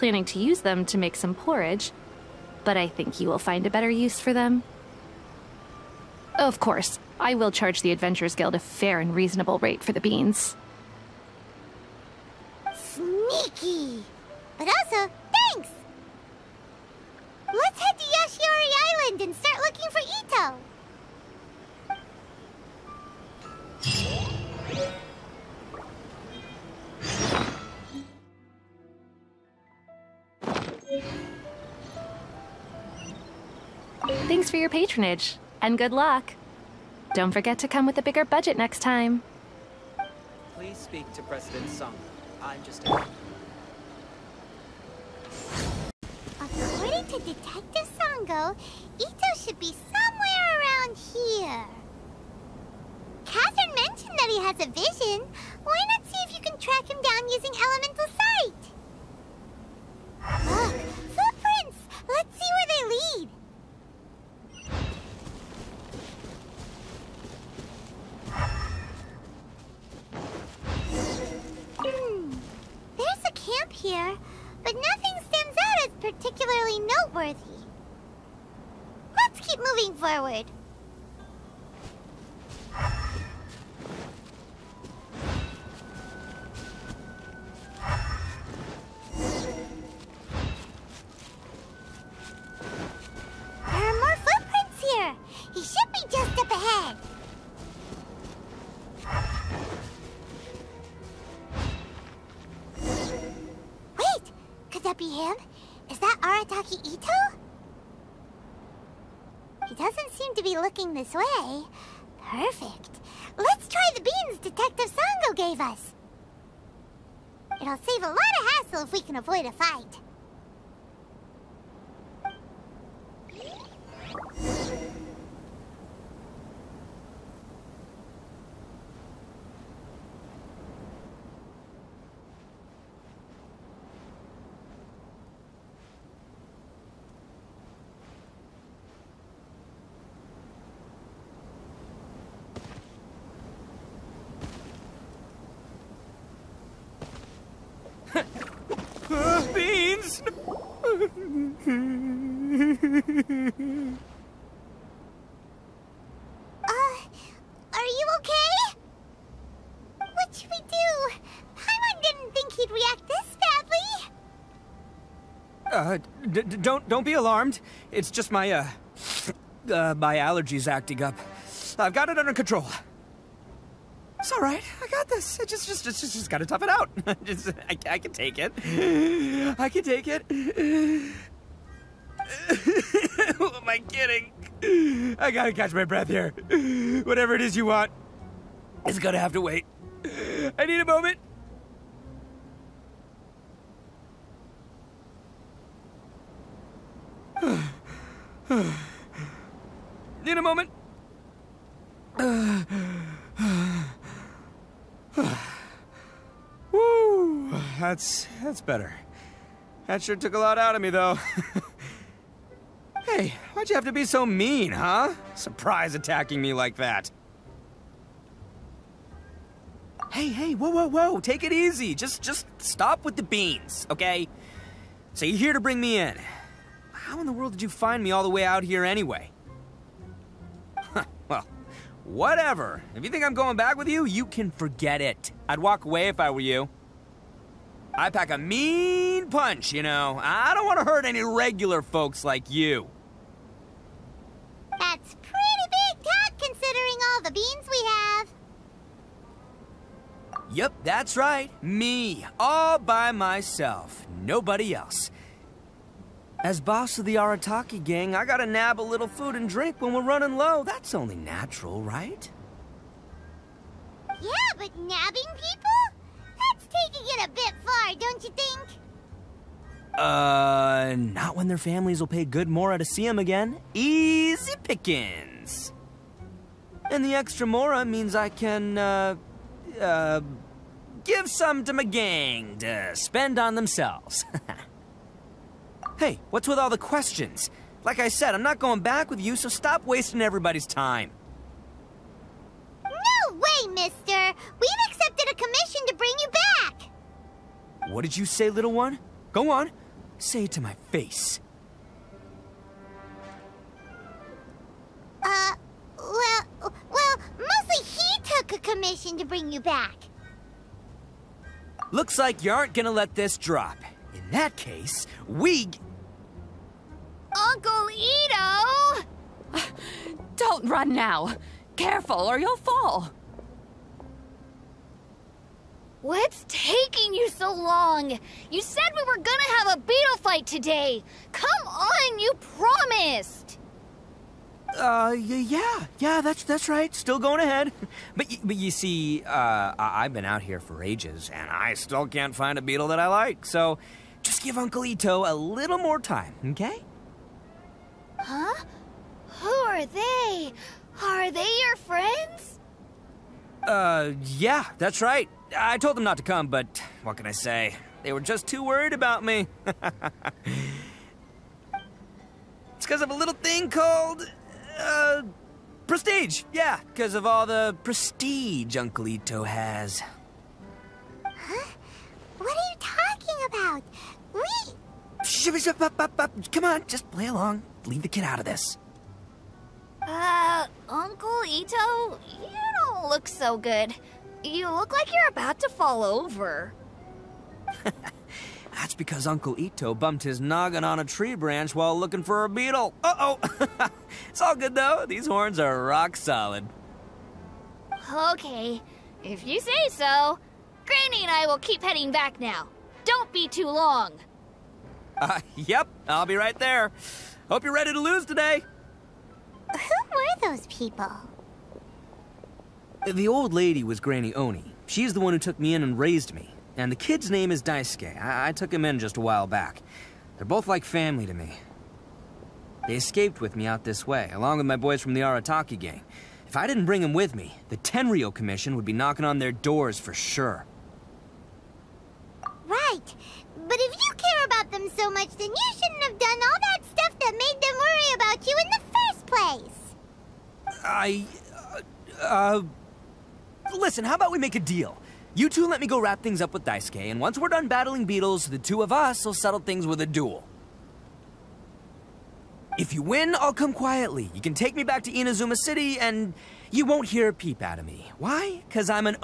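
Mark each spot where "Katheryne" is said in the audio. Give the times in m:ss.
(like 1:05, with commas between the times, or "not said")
0:53.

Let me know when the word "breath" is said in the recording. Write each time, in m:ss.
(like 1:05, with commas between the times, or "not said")
3:05.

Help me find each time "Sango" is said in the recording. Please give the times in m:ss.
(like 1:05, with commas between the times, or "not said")
0:47, 1:54.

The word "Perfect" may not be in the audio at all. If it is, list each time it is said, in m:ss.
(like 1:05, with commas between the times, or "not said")
1:52.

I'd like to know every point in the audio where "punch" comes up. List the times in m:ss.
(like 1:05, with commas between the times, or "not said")
3:59.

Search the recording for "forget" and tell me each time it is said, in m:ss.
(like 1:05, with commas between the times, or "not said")
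0:37, 3:54.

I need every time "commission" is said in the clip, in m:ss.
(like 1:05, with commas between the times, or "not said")
4:55, 5:08, 7:08.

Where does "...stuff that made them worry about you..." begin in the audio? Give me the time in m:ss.
7:16.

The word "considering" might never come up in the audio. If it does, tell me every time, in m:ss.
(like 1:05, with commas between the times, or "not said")
4:06.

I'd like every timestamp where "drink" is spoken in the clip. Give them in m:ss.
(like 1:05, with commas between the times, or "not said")
4:19.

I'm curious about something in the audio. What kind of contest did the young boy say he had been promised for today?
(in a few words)
beetle fight.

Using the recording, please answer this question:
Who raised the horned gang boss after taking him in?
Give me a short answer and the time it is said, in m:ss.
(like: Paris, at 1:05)
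Granny Oni, at 6:53.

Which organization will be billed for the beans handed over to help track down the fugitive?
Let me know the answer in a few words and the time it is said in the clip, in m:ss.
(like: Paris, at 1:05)
Adventurers Guild, at 0:07.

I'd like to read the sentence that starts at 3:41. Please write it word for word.
Just, just stop with the beans, okay?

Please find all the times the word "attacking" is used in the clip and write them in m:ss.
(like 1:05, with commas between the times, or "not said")
3:35.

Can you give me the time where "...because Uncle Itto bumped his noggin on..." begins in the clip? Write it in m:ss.
6:28.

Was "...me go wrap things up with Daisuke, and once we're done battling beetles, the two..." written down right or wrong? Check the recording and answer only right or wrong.
right.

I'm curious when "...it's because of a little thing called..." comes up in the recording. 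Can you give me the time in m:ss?
5:59.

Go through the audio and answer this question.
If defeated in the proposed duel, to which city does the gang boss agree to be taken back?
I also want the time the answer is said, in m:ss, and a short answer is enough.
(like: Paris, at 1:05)
Inazuma City, at 7:35.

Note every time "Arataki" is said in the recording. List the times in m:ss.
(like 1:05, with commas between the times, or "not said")
4:17, 7:05.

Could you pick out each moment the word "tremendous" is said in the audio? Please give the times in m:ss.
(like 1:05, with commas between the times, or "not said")
not said.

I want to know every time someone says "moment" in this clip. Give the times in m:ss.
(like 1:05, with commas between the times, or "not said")
3:10, 3:20.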